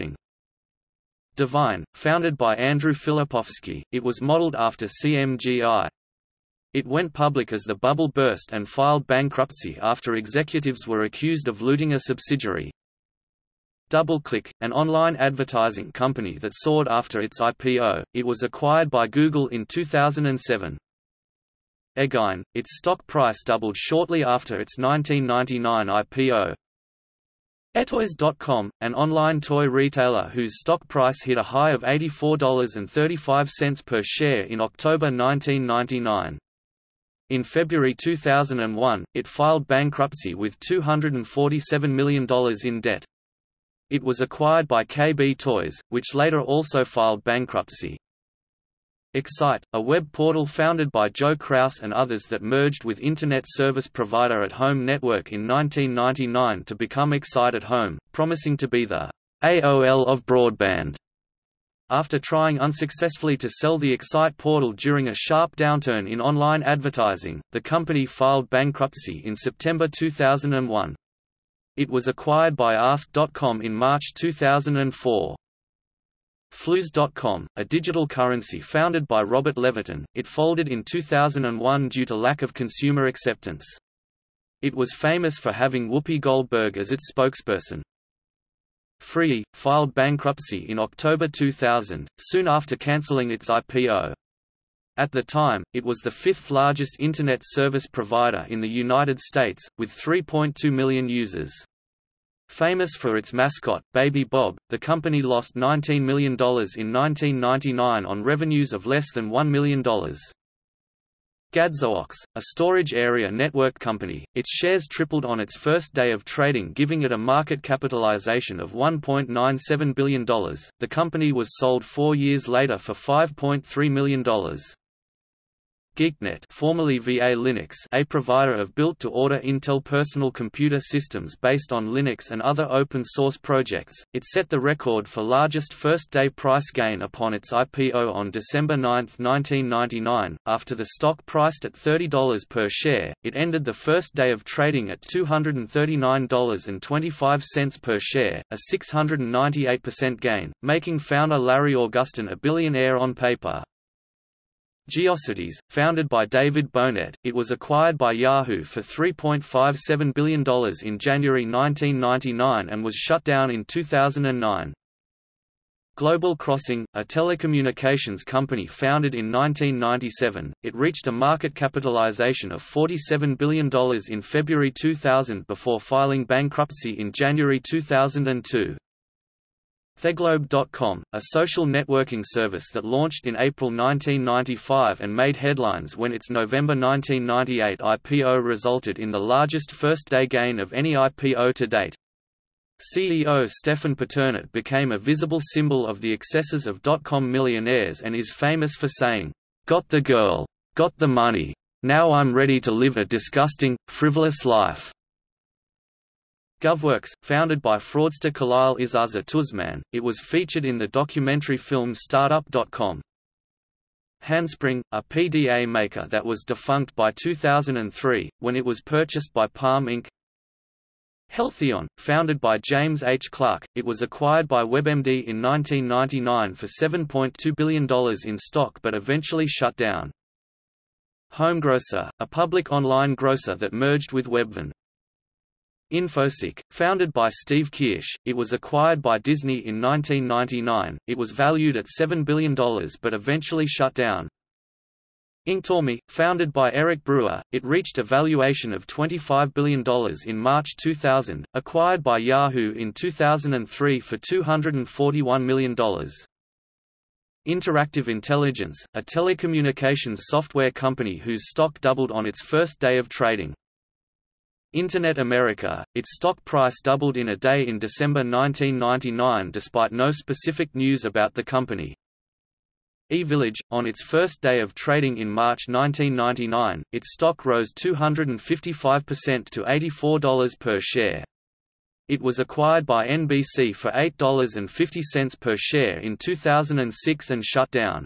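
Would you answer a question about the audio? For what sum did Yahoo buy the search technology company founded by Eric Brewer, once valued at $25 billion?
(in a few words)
$241 million.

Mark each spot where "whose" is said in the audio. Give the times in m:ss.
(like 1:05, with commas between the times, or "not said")
0:30, 4:21.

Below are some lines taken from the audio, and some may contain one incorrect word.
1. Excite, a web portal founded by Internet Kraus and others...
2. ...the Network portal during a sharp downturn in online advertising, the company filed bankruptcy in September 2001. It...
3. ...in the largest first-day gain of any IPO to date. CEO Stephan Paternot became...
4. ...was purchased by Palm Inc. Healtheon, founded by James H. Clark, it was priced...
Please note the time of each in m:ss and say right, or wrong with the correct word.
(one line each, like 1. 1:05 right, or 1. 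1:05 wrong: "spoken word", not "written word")
1. 0:49 wrong: "Joe", not "Internet"
2. 1:03 wrong: "Excite", not "Network"
3. 3:08 right
4. 3:38 wrong: "acquired", not "priced".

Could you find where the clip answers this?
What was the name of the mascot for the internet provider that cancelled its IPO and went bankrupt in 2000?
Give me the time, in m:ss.
1:43.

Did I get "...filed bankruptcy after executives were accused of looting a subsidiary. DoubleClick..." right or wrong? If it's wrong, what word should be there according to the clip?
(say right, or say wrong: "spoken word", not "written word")
right.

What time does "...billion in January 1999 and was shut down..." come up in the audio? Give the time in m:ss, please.
2:40.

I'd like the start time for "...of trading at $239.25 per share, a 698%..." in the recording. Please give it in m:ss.
2:24.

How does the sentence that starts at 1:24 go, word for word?
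It was famous for having Whoopi Goldberg as its spokesperson.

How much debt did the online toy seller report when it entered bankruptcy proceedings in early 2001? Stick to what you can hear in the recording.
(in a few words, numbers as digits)
$247 million.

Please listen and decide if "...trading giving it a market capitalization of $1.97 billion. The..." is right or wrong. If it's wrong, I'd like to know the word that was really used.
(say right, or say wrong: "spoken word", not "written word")
right.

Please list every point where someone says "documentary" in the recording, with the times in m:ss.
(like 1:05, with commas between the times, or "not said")
3:30.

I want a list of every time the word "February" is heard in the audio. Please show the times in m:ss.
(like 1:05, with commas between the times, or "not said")
0:37, 2:54.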